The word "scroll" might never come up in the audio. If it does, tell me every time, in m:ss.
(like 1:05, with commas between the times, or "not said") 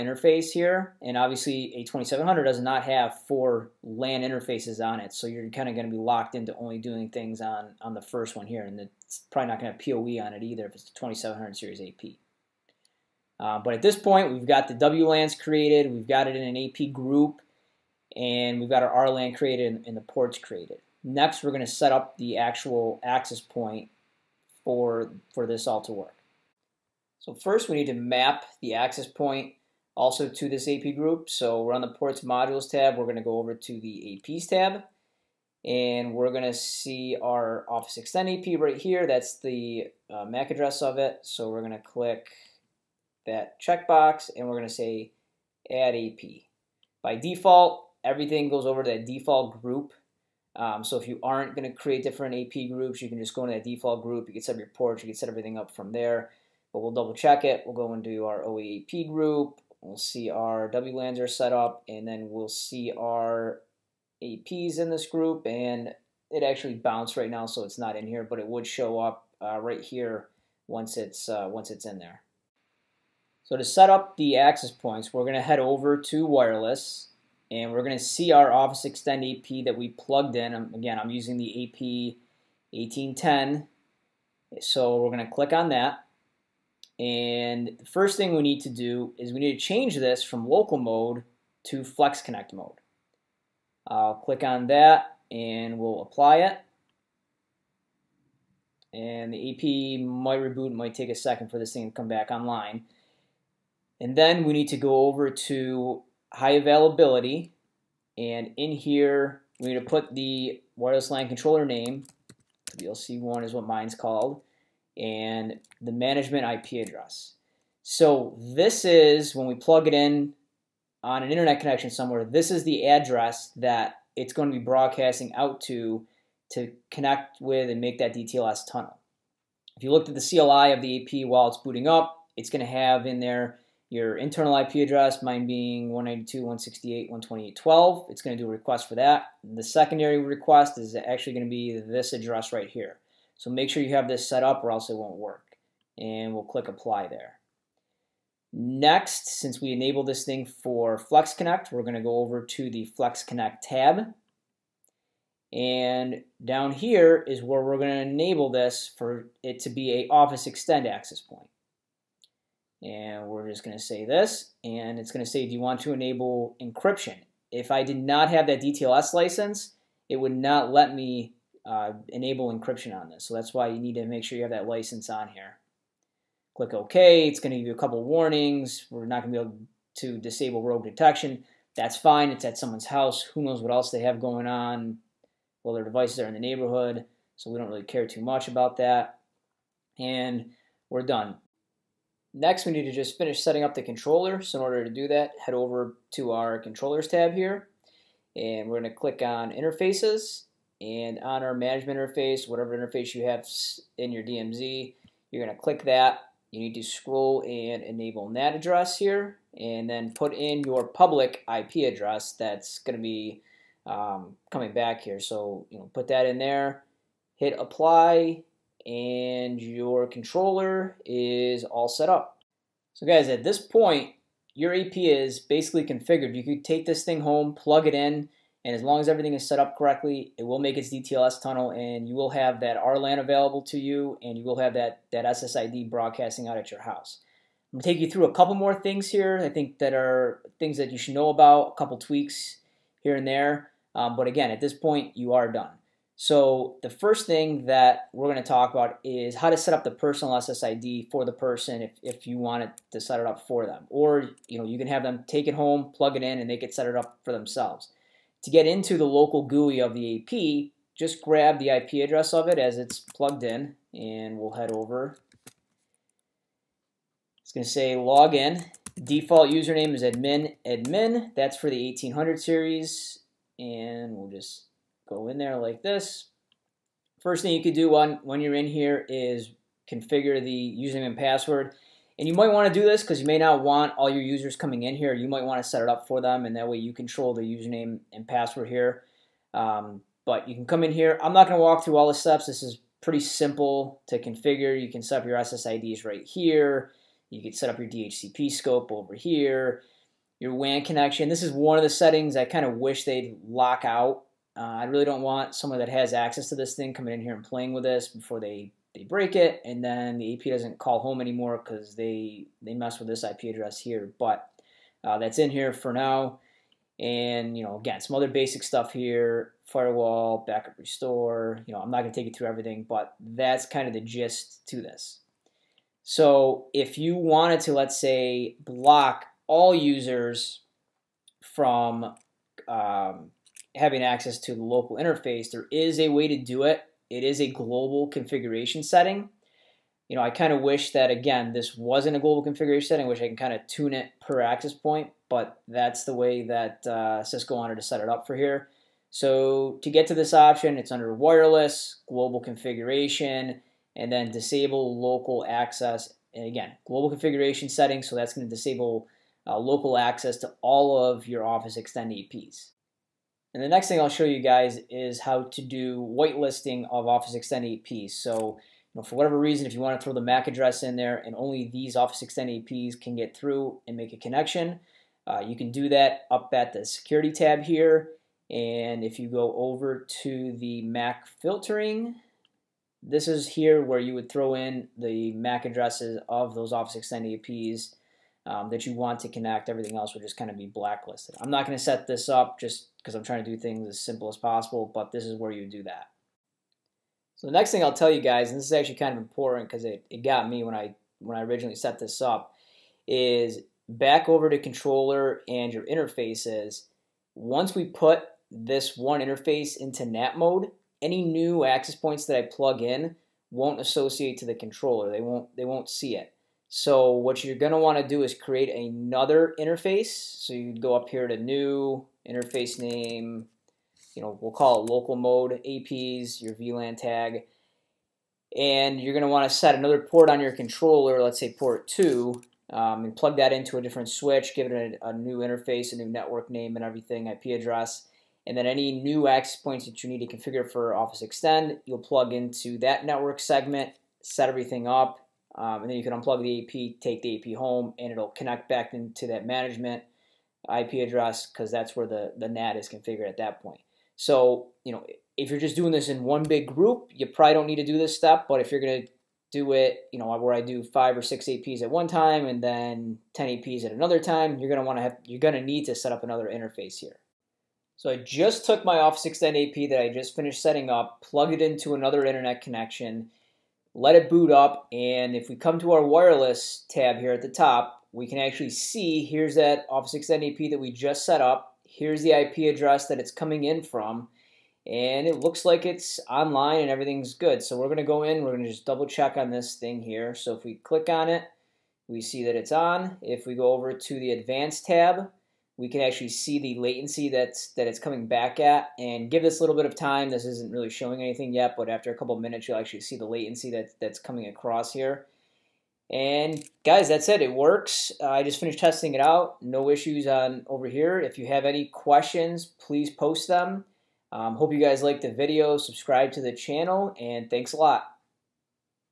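3:26.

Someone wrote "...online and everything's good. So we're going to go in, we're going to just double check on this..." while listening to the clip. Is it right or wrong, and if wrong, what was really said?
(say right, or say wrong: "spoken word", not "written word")
right.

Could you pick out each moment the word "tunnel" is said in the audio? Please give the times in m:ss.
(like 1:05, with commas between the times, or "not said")
2:08, 3:51.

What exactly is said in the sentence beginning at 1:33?
I'll click on that and we'll apply it.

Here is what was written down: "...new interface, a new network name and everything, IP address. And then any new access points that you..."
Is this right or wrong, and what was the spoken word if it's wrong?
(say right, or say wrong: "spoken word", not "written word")
right.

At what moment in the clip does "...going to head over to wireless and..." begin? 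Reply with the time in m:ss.
1:15.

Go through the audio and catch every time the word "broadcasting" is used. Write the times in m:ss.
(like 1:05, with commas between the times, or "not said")
2:04, 3:55.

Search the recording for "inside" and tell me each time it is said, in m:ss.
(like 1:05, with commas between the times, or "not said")
not said.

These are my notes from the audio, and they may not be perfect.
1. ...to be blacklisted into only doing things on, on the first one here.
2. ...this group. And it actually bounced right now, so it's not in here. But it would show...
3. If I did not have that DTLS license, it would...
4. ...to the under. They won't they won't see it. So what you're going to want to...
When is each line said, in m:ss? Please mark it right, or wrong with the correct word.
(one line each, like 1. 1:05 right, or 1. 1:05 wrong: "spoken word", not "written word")
1. 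0:05 wrong: "locked", not "blacklisted"
2. 1:04 right
3. 2:47 right
4. 6:54 wrong: "controller", not "under".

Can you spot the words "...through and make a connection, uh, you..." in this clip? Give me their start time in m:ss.
6:13.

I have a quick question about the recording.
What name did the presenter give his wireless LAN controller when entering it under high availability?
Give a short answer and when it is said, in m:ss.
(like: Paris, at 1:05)
VLC1, at 1:52.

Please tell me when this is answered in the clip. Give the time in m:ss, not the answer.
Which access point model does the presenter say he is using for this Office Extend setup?
1:21.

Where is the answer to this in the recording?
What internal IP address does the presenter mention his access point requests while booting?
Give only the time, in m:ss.
2:15.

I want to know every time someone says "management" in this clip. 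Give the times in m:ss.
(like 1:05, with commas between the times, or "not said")
1:55, 3:21, 7:29.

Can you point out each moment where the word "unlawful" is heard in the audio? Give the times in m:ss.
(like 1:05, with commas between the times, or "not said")
not said.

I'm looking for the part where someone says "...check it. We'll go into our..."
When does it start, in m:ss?
0:57.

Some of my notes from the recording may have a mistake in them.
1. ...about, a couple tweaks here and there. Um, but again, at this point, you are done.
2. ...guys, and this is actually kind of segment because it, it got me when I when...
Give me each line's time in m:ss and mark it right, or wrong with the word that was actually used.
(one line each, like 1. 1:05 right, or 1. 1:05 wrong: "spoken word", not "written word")
1. 4:01 right
2. 6:38 wrong: "important", not "segment".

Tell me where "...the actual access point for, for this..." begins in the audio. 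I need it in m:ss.
0:22.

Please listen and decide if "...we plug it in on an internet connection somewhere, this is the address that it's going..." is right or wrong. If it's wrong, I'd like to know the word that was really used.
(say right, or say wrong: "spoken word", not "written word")
right.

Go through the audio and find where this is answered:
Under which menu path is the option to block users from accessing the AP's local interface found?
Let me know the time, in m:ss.
5:51.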